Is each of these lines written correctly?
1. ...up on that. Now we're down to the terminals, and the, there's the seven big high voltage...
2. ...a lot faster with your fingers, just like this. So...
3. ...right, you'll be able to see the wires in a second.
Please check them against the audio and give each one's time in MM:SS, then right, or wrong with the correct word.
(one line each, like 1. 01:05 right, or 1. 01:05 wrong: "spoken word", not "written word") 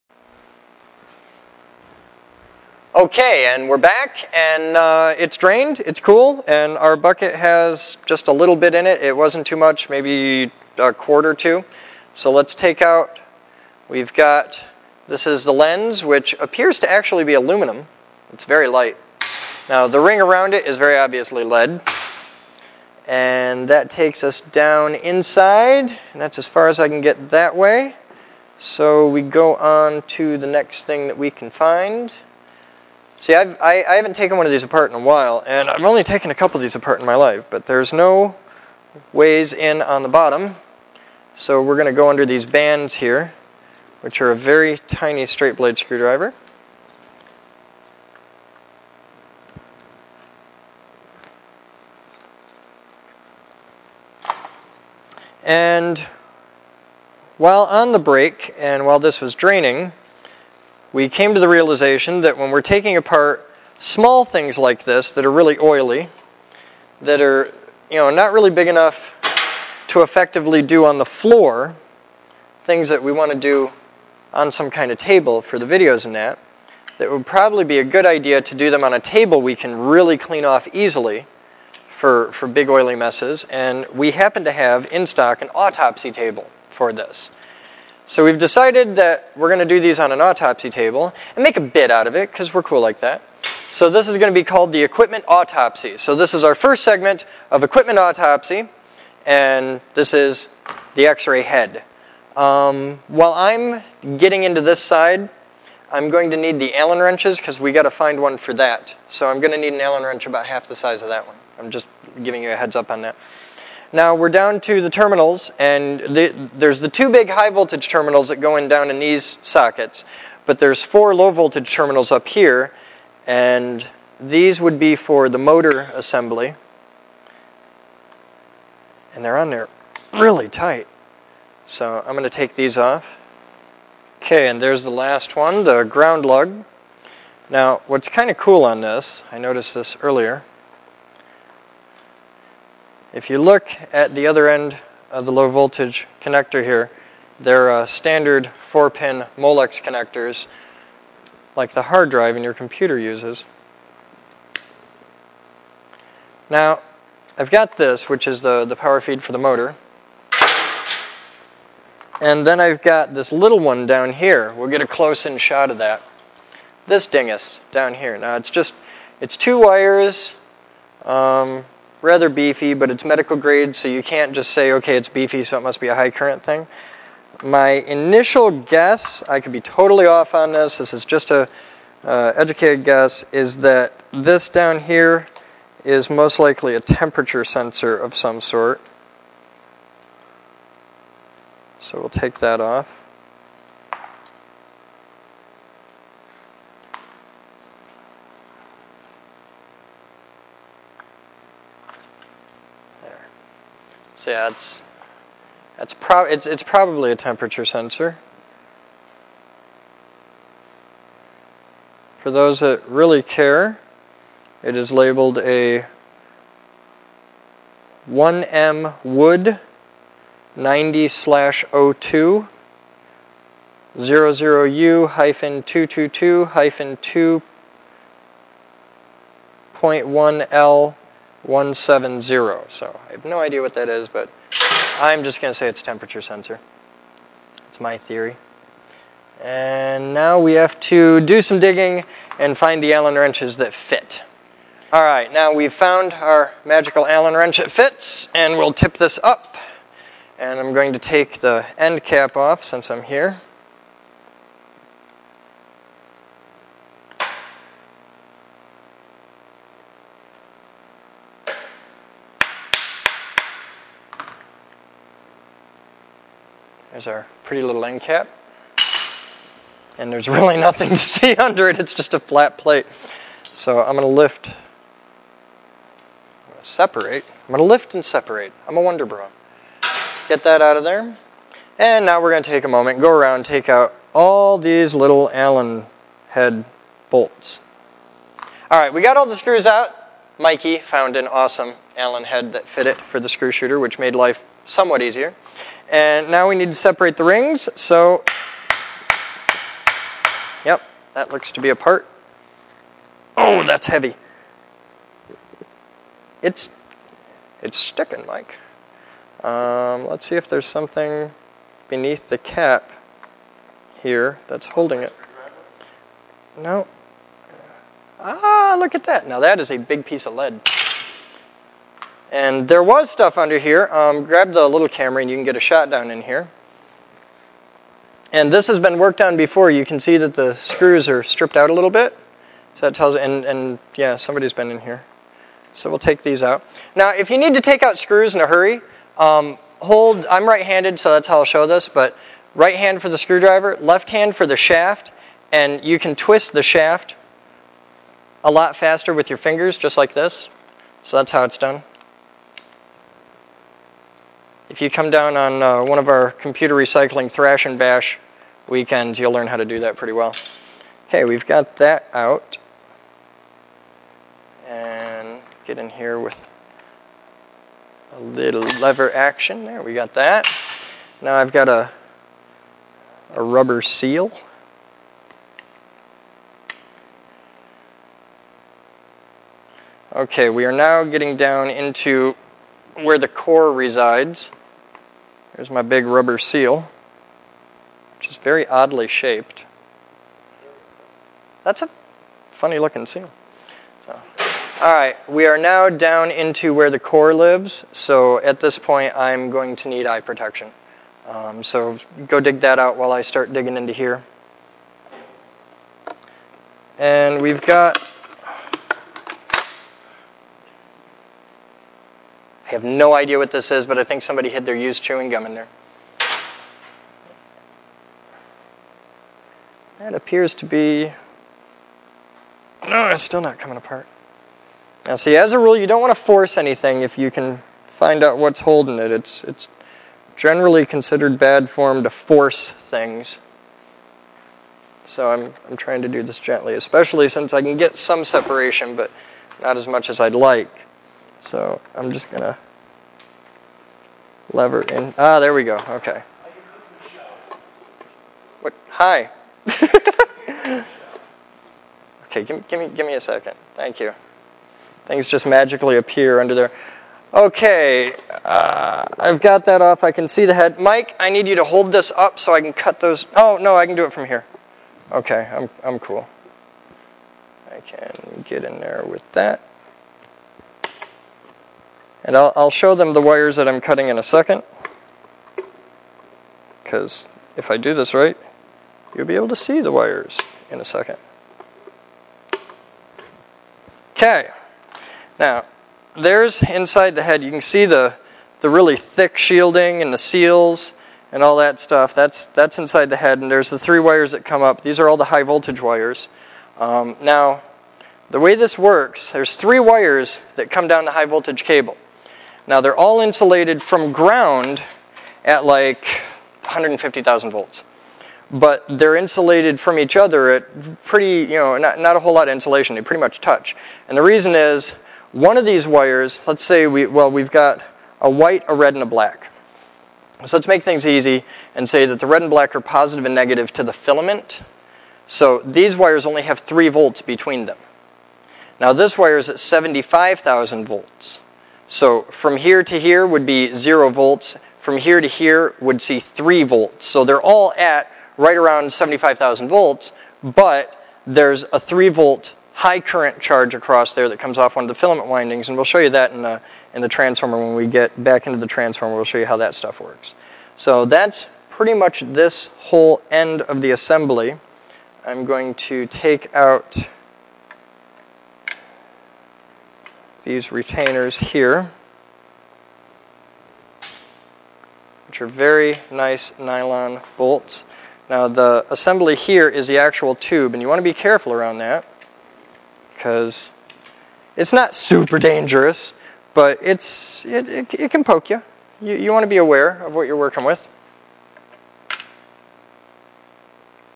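1. 01:52 wrong: "two", not "seven"
2. 05:48 right
3. 07:58 right.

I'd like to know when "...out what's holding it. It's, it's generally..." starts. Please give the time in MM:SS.
07:08.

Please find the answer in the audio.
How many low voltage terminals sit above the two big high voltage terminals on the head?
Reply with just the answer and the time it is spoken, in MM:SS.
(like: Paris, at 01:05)
4, at 02:00.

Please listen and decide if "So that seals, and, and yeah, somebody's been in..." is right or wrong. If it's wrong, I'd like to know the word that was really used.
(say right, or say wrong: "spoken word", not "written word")
wrong: "tells", not "seals".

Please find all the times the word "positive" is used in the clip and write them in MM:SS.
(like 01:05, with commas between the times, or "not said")
08:42.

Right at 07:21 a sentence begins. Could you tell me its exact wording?
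So I'm just gonna lever in.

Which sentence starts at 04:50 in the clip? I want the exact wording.
Mikey found an awesome Allen head that fit it for the screw shooter, which made life somewhat easier.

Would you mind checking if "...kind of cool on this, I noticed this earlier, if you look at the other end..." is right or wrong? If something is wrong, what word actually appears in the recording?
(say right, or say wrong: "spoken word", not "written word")
right.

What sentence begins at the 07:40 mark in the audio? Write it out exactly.
Mike, I need you to hold this up so I can cut those.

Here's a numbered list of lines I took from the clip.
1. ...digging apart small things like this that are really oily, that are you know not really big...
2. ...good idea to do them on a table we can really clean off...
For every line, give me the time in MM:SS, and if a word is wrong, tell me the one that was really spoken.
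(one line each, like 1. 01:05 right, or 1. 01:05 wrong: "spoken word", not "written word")
1. 01:02 wrong: "taking", not "digging"
2. 01:17 right.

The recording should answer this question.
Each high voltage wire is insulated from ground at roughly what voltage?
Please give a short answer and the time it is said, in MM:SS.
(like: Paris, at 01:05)
150,000 volts, at 08:26.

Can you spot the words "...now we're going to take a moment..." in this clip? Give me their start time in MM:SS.
04:42.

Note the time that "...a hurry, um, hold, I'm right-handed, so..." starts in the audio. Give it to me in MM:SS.
05:38.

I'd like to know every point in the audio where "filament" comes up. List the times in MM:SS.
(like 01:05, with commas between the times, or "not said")
08:43, 09:04.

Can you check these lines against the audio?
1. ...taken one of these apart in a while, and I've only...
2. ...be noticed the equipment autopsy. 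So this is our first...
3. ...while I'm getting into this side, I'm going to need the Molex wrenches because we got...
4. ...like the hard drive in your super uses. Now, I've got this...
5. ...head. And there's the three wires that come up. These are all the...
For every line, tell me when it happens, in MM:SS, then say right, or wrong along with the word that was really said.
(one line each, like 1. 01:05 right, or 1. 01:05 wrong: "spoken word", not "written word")
1. 00:34 right
2. 01:34 wrong: "called", not "noticed"
3. 01:43 wrong: "Allen", not "Molex"
4. 02:31 wrong: "computer", not "super"
5. 08:13 right.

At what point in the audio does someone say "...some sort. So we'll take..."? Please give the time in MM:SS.
03:08.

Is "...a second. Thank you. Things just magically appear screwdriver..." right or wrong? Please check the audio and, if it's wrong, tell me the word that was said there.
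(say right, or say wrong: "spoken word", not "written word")
wrong: "under", not "screwdriver".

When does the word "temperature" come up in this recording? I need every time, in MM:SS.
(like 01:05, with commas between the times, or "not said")
03:06, 03:27, 03:55.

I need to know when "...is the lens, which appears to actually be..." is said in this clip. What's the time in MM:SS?
00:15.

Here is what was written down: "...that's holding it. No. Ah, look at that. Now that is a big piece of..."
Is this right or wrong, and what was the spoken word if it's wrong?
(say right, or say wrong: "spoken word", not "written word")
right.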